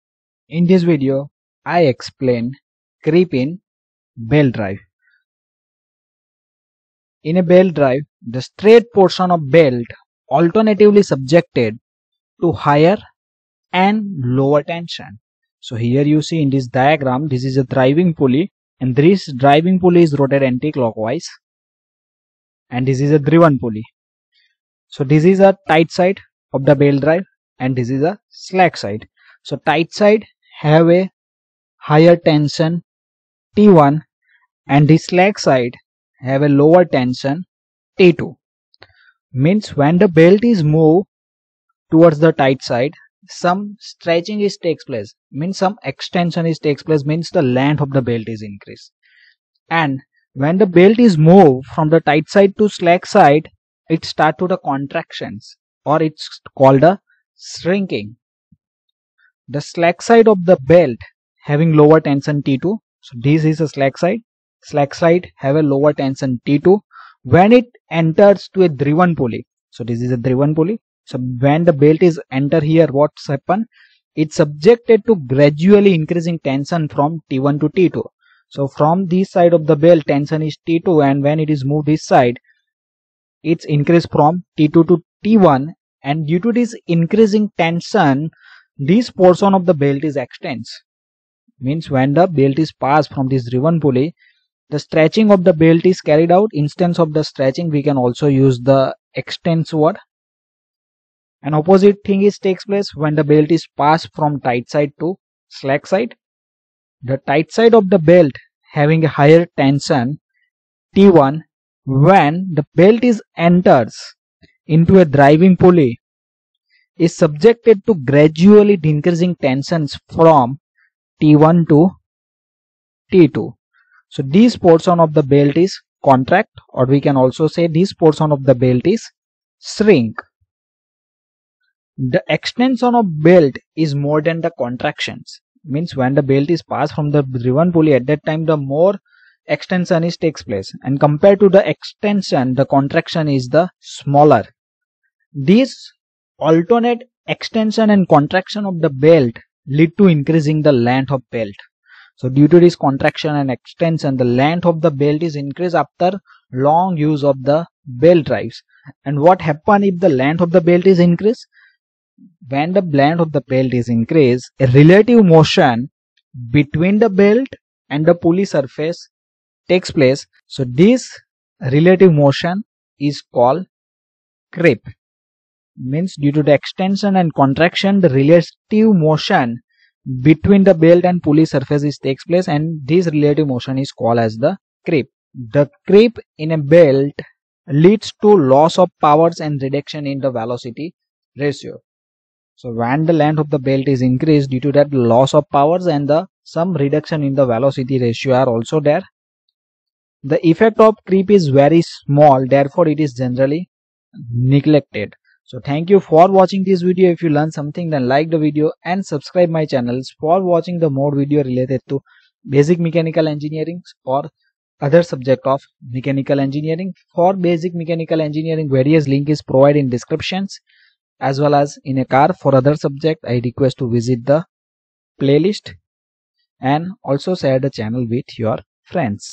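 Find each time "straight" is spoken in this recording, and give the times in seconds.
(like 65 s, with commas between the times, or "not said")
8 s.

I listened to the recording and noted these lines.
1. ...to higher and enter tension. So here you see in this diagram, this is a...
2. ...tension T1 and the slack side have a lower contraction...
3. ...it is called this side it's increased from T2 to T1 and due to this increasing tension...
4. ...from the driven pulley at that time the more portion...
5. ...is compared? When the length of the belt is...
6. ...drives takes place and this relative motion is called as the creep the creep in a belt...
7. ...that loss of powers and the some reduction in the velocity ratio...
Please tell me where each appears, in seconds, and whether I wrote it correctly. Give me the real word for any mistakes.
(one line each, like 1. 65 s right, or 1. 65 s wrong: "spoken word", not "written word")
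1. 12 s wrong: "lower", not "enter"
2. 32 s wrong: "tension", not "contraction"
3. 81 s wrong: "moved", not "called"
4. 136 s wrong: "extension", not "portion"
5. 160 s wrong: "increased", not "compared"
6. 181 s wrong: "surfaces", not "drives"
7. 194 s right.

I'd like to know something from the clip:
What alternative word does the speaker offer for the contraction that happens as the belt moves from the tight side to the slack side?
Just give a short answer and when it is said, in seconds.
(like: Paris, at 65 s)
Shrinking, at 57 s.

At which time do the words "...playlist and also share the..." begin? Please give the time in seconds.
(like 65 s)
225 s.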